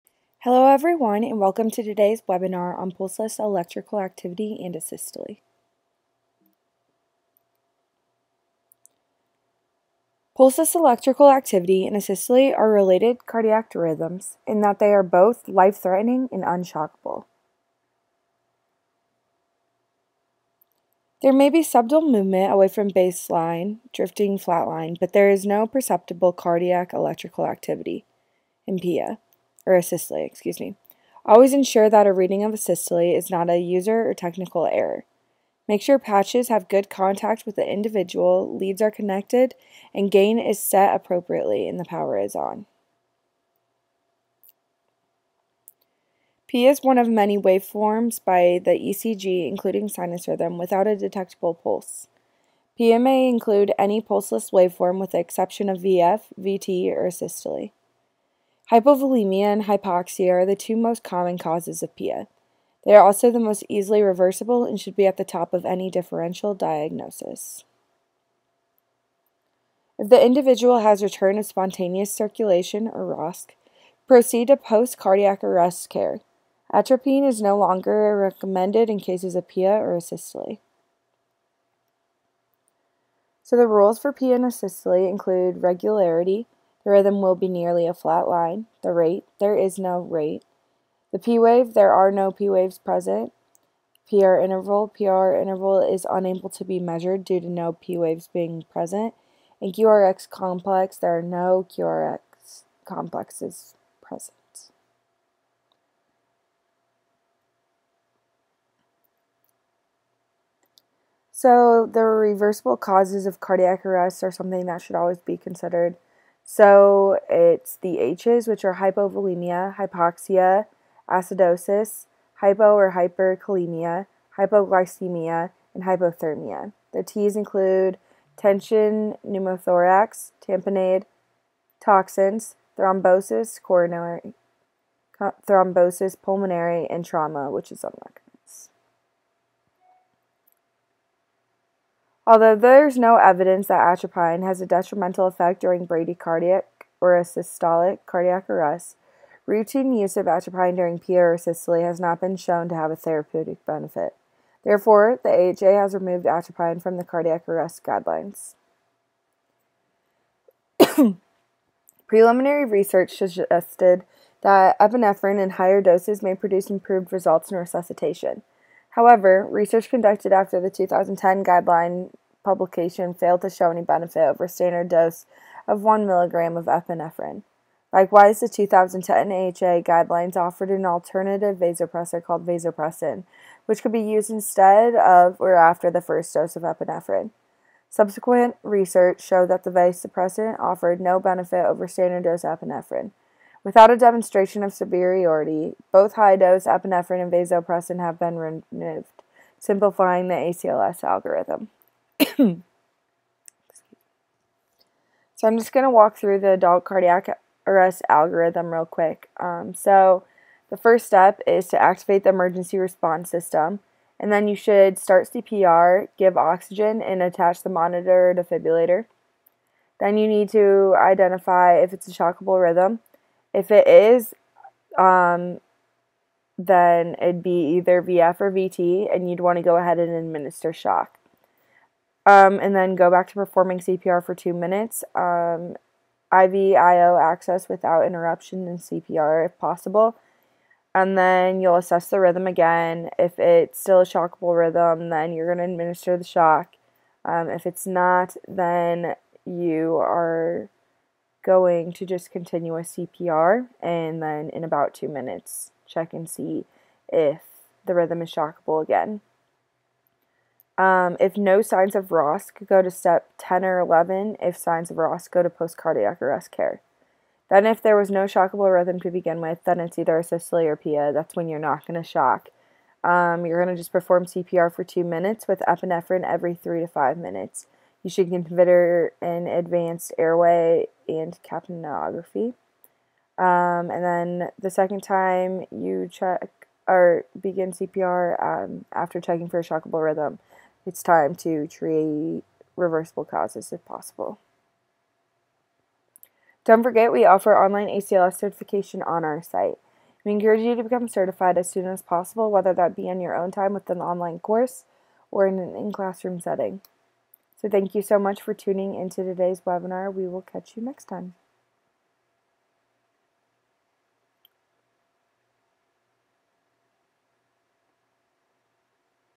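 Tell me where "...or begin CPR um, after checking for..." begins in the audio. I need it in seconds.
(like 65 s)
286 s.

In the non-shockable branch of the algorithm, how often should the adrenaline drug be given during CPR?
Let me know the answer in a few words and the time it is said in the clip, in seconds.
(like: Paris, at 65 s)
every 3 to 5 minutes, at 276 s.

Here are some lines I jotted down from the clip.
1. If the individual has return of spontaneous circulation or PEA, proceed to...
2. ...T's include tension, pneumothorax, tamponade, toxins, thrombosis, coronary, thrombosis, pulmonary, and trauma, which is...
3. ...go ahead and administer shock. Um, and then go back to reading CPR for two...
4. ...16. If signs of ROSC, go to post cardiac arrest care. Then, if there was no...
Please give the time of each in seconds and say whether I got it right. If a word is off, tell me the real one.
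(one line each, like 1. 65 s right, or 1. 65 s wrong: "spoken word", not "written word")
1. 69 s wrong: "ROSC", not "PEA"
2. 127 s right
3. 229 s wrong: "performing", not "reading"
4. 263 s wrong: "11", not "16".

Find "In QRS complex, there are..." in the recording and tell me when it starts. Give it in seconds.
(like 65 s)
99 s.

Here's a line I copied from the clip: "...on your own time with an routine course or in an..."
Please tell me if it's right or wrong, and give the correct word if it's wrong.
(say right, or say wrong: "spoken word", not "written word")
wrong: "online", not "routine".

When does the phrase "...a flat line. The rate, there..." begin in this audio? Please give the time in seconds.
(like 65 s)
87 s.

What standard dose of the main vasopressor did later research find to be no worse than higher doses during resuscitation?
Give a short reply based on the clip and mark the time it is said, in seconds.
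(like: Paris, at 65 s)
1 milligram, at 175 s.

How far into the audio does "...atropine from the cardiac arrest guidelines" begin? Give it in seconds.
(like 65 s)
156 s.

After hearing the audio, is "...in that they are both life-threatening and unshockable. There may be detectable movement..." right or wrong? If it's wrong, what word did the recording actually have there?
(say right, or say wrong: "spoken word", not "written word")
wrong: "subtle", not "detectable".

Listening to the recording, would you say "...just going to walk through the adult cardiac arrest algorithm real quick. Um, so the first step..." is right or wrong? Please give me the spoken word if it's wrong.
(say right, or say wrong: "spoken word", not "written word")
right.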